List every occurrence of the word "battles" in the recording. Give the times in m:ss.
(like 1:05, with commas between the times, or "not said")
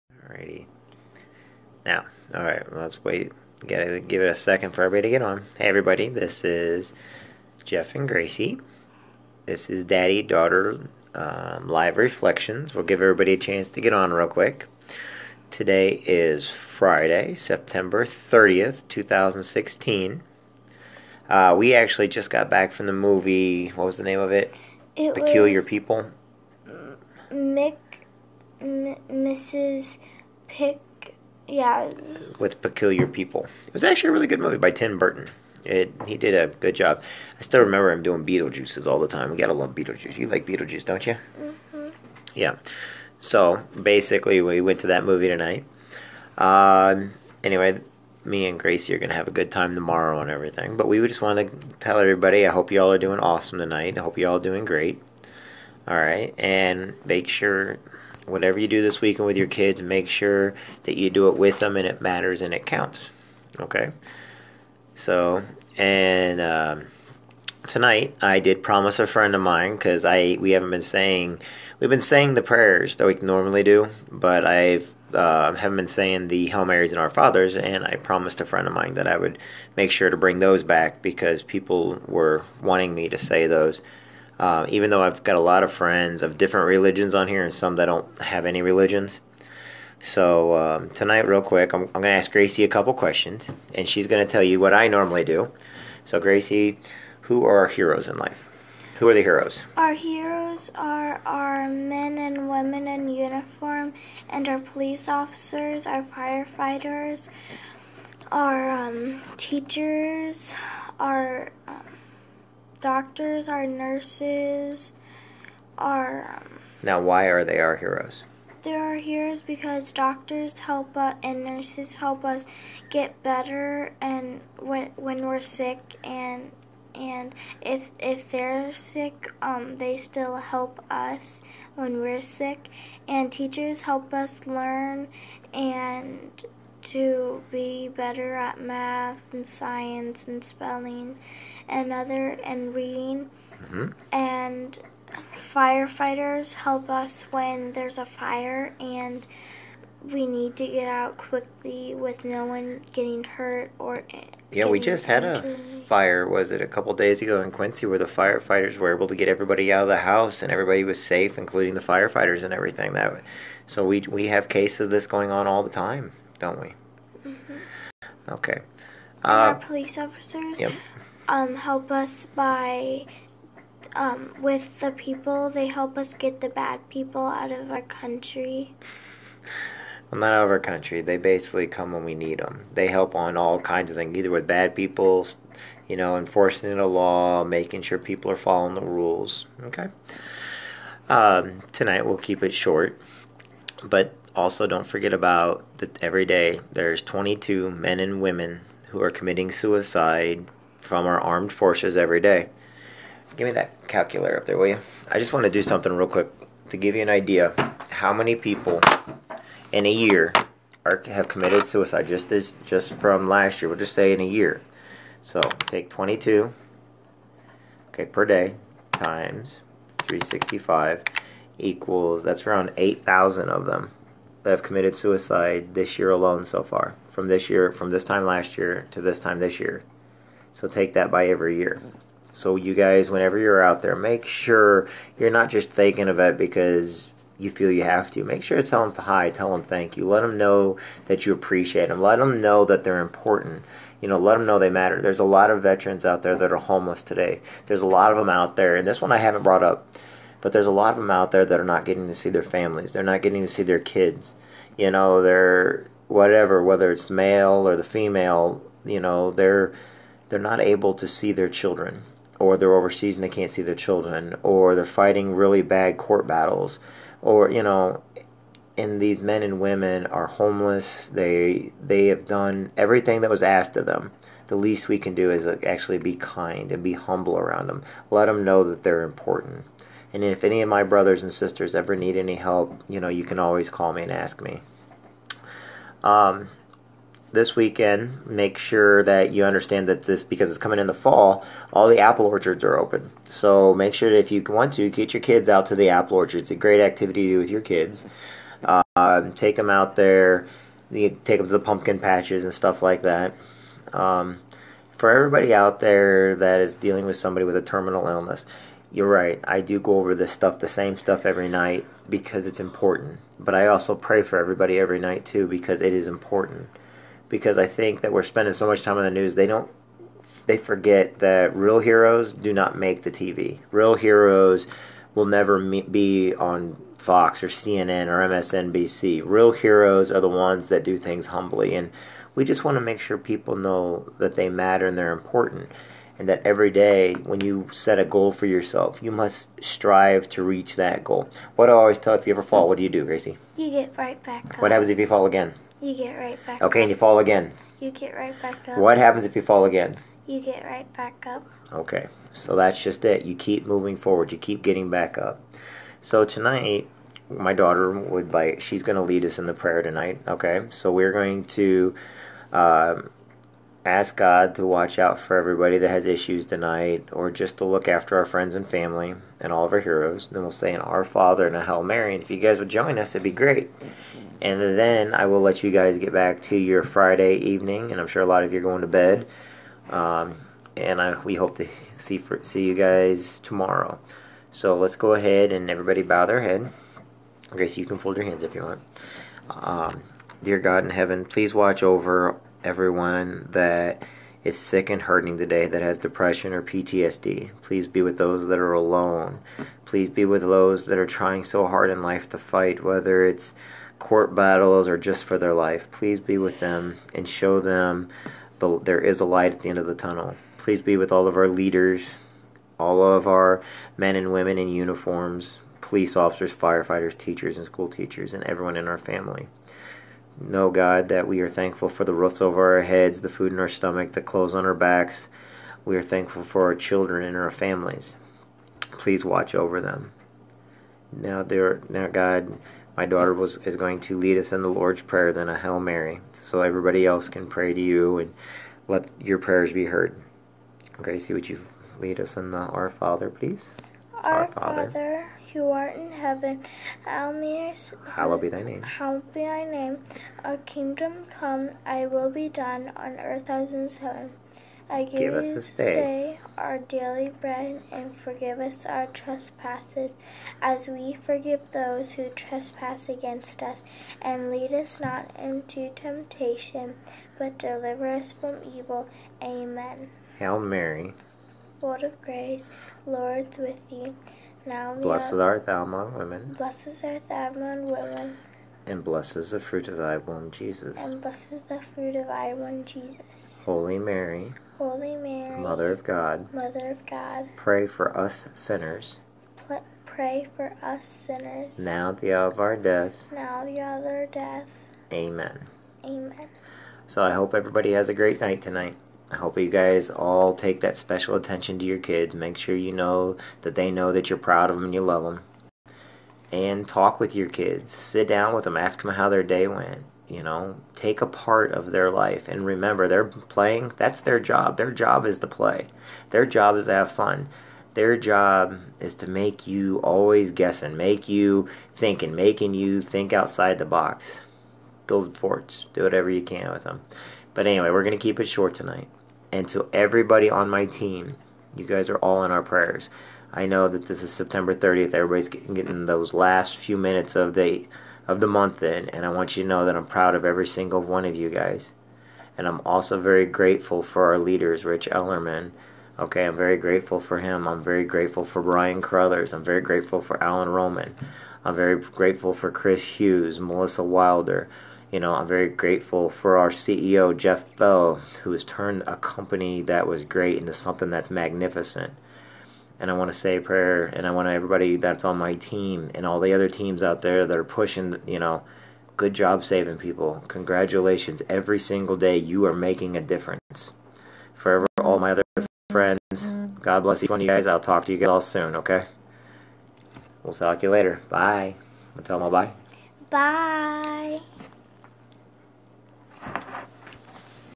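4:26, 6:44.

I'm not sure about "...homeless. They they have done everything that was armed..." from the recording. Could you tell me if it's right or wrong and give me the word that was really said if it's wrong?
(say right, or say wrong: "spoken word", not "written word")
wrong: "asked", not "armed".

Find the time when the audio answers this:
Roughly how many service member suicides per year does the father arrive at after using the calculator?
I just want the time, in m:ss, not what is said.
3:42.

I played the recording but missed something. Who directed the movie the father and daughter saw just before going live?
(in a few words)
Tim Burton.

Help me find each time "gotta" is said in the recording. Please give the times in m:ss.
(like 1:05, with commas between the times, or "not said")
0:03, 0:39.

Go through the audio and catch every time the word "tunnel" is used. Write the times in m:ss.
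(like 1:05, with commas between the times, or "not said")
6:49.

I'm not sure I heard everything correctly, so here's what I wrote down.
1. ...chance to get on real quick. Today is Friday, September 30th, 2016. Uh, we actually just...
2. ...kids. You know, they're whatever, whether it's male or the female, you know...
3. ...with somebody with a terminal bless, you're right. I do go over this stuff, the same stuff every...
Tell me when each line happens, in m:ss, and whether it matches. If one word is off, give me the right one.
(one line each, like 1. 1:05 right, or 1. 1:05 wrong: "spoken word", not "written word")
1. 0:13 right
2. 4:13 right
3. 5:07 wrong: "illness", not "bless".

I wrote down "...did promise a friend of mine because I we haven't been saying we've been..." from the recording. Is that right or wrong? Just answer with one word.
right.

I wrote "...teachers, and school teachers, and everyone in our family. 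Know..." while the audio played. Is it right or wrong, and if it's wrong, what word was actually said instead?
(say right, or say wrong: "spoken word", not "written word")
right.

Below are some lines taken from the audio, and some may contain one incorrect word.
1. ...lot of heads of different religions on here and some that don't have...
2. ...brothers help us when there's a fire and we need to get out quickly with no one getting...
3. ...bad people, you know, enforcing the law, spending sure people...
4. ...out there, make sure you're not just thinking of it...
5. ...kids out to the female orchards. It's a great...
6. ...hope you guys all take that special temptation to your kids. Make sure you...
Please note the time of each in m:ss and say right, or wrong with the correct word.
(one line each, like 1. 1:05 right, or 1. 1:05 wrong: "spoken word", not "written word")
1. 1:25 wrong: "friends", not "heads"
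2. 2:25 wrong: "firefighters", not "brothers"
3. 3:04 wrong: "making", not "spending"
4. 3:53 right
5. 4:55 wrong: "apple", not "female"
6. 8:19 wrong: "attention", not "temptation".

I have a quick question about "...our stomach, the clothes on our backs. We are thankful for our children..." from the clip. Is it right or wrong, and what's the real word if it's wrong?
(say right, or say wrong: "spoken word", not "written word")
right.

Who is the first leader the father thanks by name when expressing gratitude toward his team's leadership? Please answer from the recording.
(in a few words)
Rich Ellerman.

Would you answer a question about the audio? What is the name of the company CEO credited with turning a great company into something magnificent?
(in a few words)
Jeff Bell.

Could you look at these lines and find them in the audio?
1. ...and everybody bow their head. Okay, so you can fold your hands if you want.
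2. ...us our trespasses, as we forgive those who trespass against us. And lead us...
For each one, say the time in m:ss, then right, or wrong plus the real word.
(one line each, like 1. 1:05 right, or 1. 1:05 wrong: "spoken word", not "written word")
1. 6:25 right
2. 7:38 right.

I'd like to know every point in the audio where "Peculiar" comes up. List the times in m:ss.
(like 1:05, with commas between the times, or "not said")
0:25, 0:32.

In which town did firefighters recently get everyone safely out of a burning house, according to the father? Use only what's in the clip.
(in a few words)
Quincy.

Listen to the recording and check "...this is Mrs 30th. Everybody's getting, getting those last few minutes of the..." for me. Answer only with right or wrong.
wrong.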